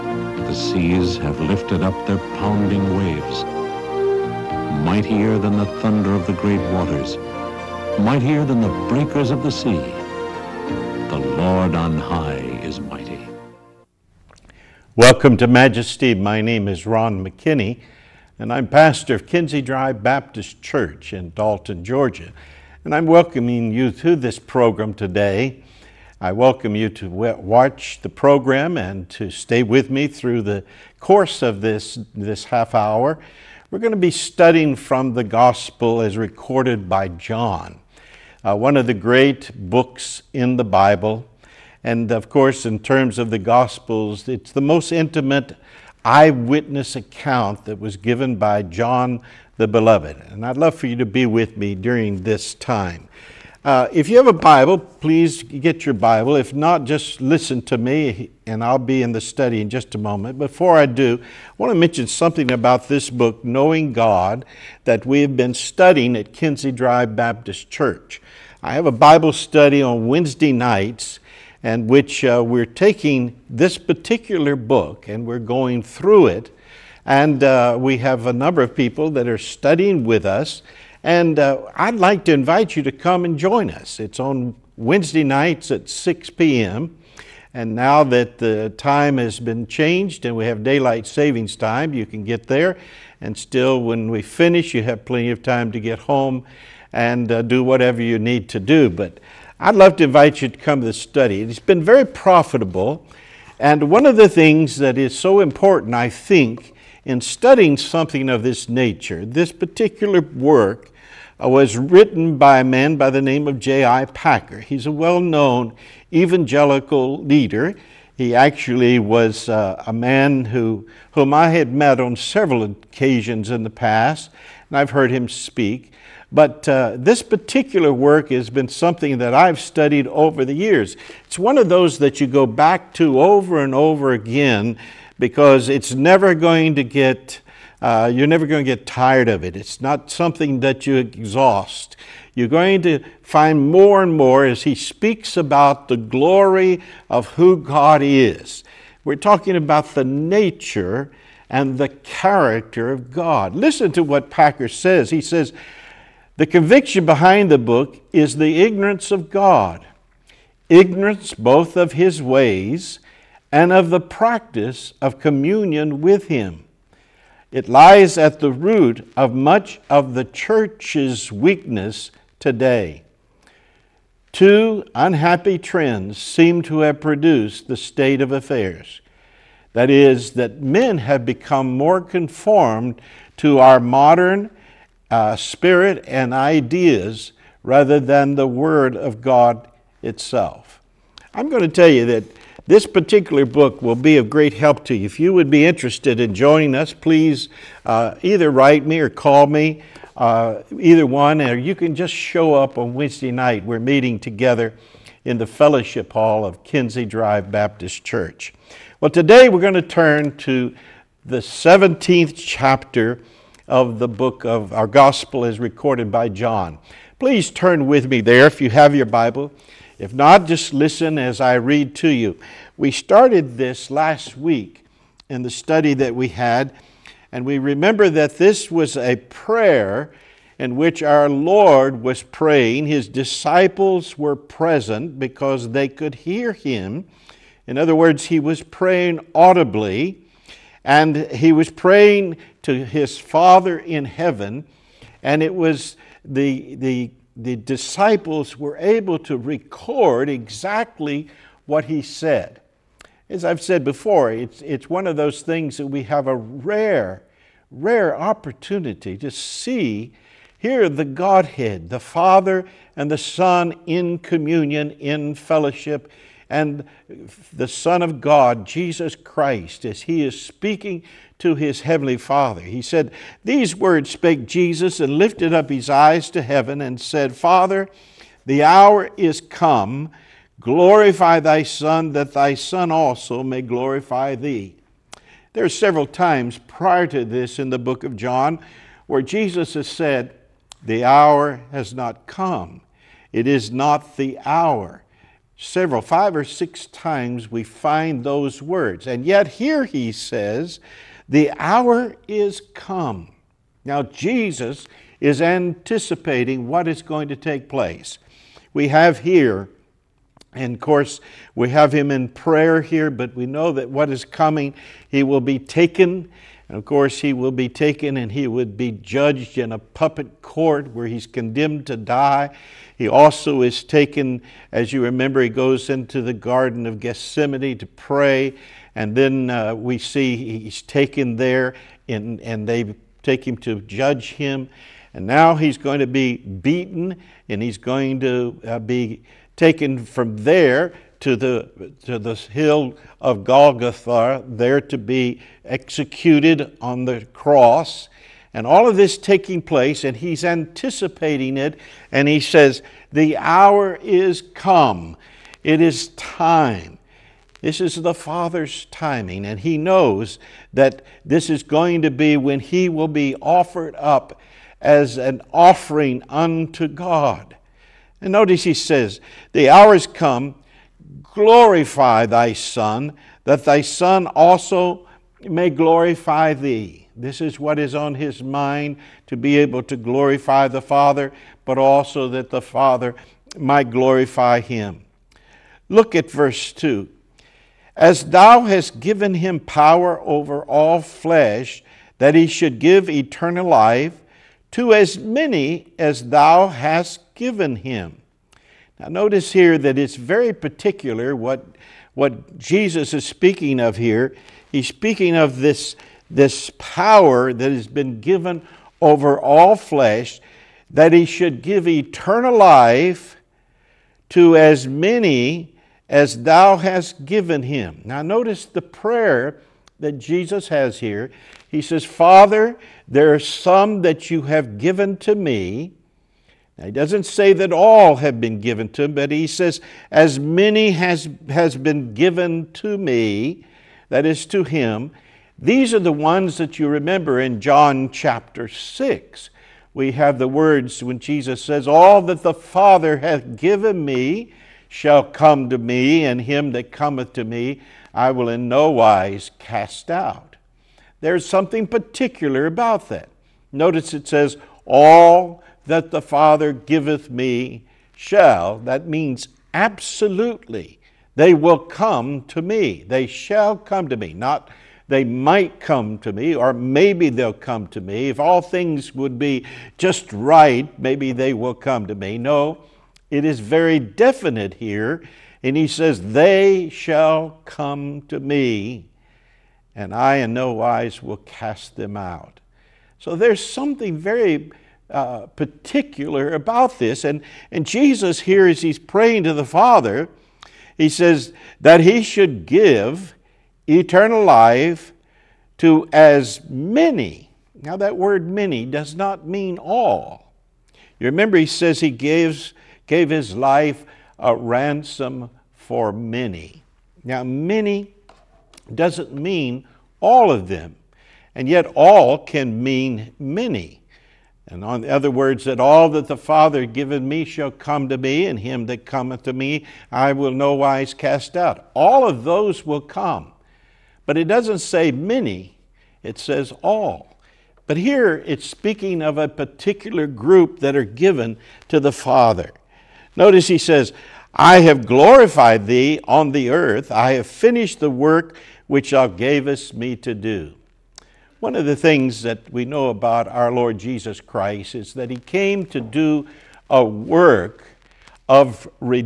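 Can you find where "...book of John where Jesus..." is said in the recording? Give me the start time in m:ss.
4:47.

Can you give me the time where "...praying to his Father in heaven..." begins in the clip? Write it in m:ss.
4:01.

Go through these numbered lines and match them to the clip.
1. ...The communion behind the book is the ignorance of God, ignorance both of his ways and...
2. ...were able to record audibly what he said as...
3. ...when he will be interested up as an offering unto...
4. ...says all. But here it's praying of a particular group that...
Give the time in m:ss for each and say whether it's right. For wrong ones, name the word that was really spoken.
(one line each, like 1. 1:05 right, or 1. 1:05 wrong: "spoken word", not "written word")
1. 2:36 wrong: "conviction", not "communion"
2. 4:08 wrong: "exactly", not "audibly"
3. 6:02 wrong: "offered", not "interested"
4. 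8:46 wrong: "speaking", not "praying".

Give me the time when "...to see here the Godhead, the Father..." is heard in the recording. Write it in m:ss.
4:19.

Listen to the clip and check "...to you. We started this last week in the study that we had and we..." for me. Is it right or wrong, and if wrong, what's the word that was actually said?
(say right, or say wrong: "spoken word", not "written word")
right.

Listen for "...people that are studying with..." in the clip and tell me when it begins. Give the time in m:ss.
1:18.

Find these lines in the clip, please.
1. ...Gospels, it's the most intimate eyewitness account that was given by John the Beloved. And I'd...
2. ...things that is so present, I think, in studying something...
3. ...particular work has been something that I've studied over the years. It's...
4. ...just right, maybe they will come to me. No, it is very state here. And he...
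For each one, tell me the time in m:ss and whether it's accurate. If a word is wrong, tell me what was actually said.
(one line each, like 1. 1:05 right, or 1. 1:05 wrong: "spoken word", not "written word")
1. 0:43 right
2. 1:44 wrong: "important", not "present"
3. 2:07 right
4. 7:49 wrong: "definite", not "state".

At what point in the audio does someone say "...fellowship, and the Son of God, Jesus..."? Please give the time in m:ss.
4:25.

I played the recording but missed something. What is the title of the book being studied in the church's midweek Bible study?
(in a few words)
Knowing God.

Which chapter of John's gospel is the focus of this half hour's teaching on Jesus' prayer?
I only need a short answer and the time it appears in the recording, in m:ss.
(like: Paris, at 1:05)
17th, at 3:31.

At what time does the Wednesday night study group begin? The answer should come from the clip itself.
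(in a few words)
6 p.m.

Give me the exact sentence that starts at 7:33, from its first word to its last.
Notice it says, All that the Father giveth me shall, that means absolutely, they will come to me.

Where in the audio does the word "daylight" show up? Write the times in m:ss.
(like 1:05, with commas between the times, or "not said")
1:30.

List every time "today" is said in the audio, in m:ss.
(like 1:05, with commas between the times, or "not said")
0:24, 2:52, 3:29.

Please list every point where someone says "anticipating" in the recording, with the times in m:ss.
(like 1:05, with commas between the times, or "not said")
5:05, 5:50.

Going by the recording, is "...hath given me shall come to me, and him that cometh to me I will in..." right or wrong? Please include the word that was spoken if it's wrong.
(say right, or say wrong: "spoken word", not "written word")
right.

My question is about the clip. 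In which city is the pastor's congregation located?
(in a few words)
Dalton, Georgia.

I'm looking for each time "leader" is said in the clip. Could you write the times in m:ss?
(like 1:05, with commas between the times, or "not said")
1:57.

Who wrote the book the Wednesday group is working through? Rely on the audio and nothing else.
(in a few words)
J.I. Packer.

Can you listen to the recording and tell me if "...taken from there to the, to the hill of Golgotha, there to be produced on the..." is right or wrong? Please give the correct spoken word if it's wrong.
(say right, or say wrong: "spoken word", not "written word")
wrong: "executed", not "produced".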